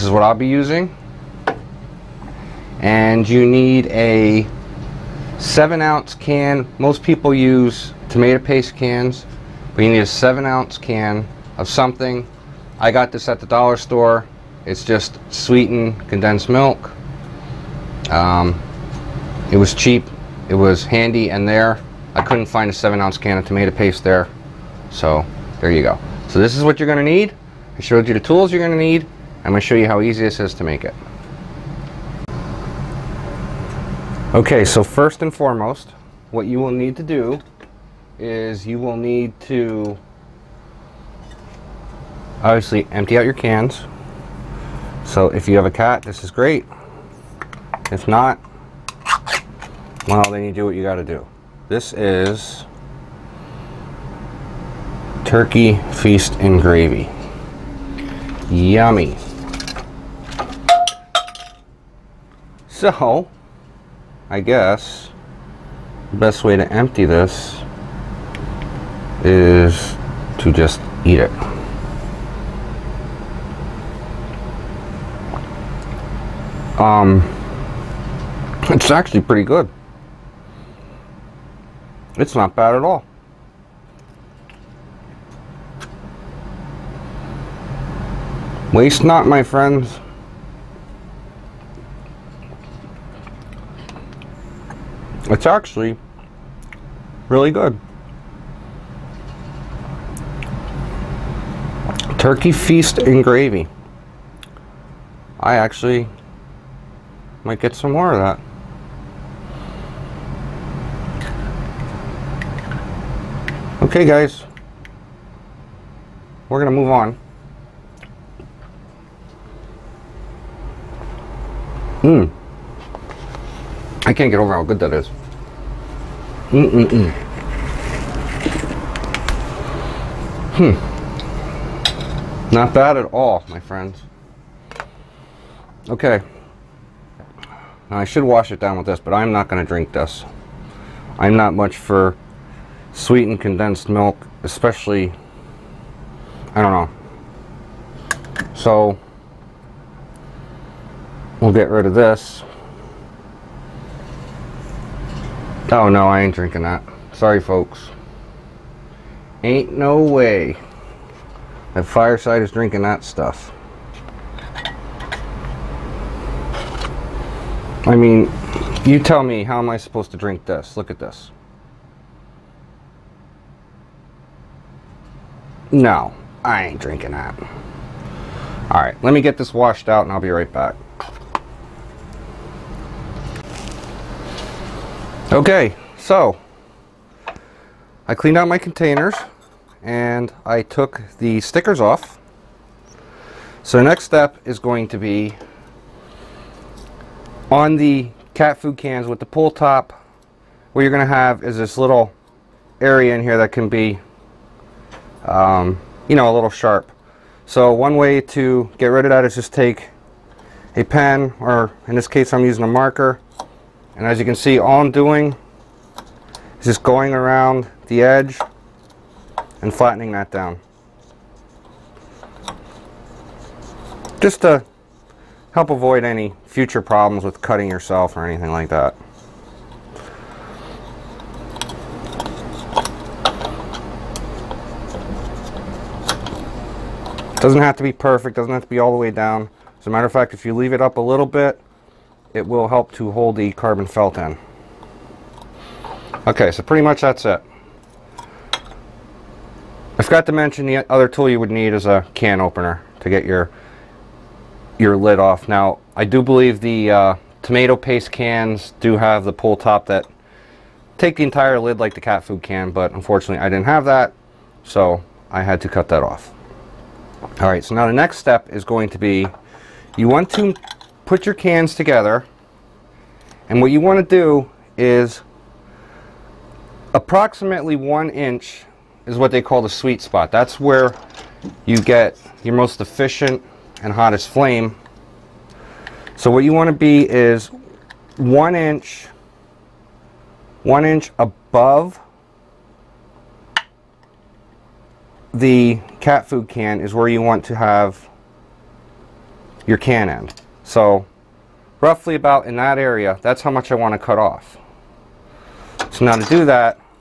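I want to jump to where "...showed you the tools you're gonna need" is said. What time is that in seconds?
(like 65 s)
27 s.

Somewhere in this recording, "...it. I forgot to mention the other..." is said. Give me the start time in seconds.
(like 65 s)
247 s.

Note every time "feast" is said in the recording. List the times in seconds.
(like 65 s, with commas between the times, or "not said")
56 s, 102 s.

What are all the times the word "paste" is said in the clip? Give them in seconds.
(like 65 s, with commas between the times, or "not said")
8 s, 23 s, 257 s.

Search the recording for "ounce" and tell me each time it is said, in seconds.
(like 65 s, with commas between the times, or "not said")
5 s, 10 s, 23 s.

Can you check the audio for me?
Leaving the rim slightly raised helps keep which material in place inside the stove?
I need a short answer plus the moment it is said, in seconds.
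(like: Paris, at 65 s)
carbon felt, at 243 s.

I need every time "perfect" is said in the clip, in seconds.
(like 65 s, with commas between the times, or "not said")
237 s.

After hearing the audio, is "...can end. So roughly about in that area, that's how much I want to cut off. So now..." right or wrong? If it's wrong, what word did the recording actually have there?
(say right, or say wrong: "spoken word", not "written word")
right.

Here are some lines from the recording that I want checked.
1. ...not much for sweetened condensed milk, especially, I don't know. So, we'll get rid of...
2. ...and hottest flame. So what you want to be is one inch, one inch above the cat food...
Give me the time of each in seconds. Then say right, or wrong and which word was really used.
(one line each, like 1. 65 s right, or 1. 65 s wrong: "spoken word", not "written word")
1. 141 s right
2. 283 s right.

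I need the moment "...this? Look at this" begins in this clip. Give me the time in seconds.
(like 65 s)
170 s.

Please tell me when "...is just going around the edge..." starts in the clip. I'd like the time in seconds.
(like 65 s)
216 s.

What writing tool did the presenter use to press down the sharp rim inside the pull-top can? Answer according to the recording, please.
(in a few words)
a marker.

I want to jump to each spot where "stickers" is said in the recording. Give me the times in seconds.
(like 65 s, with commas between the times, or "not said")
191 s.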